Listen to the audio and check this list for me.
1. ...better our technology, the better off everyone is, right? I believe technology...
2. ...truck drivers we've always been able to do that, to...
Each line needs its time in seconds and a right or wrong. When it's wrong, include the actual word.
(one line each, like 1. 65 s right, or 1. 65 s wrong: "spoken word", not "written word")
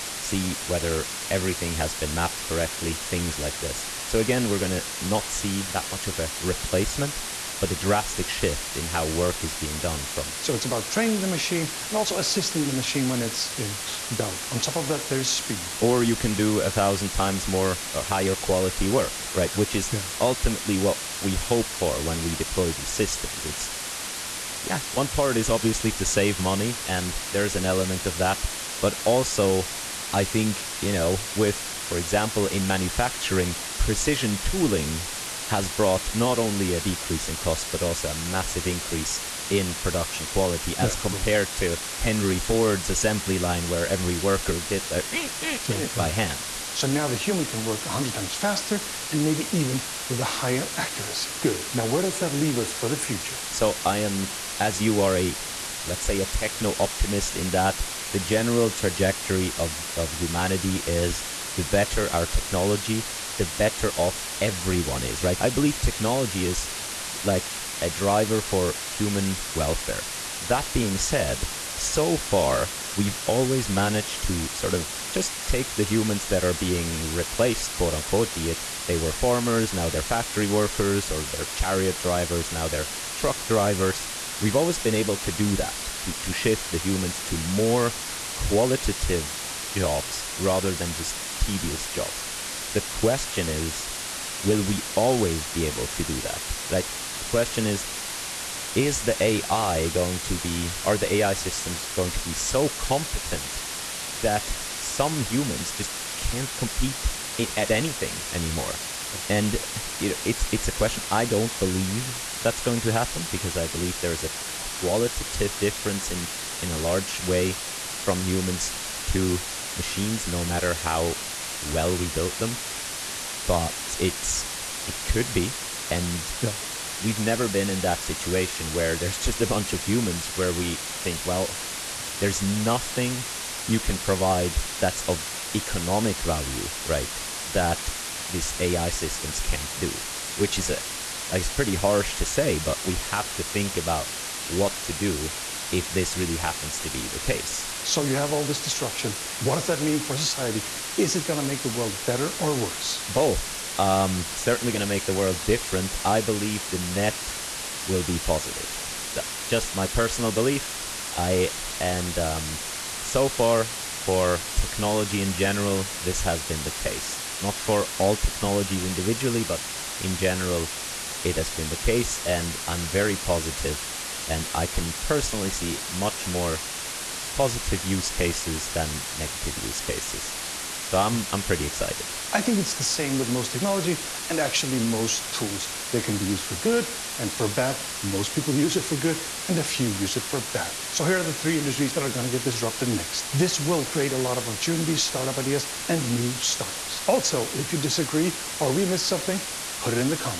1. 61 s right
2. 83 s right.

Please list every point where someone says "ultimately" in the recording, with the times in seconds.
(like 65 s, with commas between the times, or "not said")
20 s.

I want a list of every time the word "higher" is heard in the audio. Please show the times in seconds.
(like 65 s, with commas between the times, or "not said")
18 s, 50 s.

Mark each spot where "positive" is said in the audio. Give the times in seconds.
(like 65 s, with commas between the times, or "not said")
158 s, 173 s, 177 s.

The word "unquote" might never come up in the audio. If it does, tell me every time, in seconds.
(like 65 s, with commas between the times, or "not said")
77 s.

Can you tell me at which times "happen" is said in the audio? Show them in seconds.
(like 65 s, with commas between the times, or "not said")
112 s, 146 s.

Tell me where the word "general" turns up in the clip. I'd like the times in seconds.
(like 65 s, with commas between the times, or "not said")
58 s, 165 s, 170 s.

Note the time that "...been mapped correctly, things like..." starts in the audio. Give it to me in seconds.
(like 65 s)
1 s.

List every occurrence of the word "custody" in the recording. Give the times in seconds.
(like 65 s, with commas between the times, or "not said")
not said.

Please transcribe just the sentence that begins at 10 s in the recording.
So it's about training the machine and also assisting the machine when it's in doubt.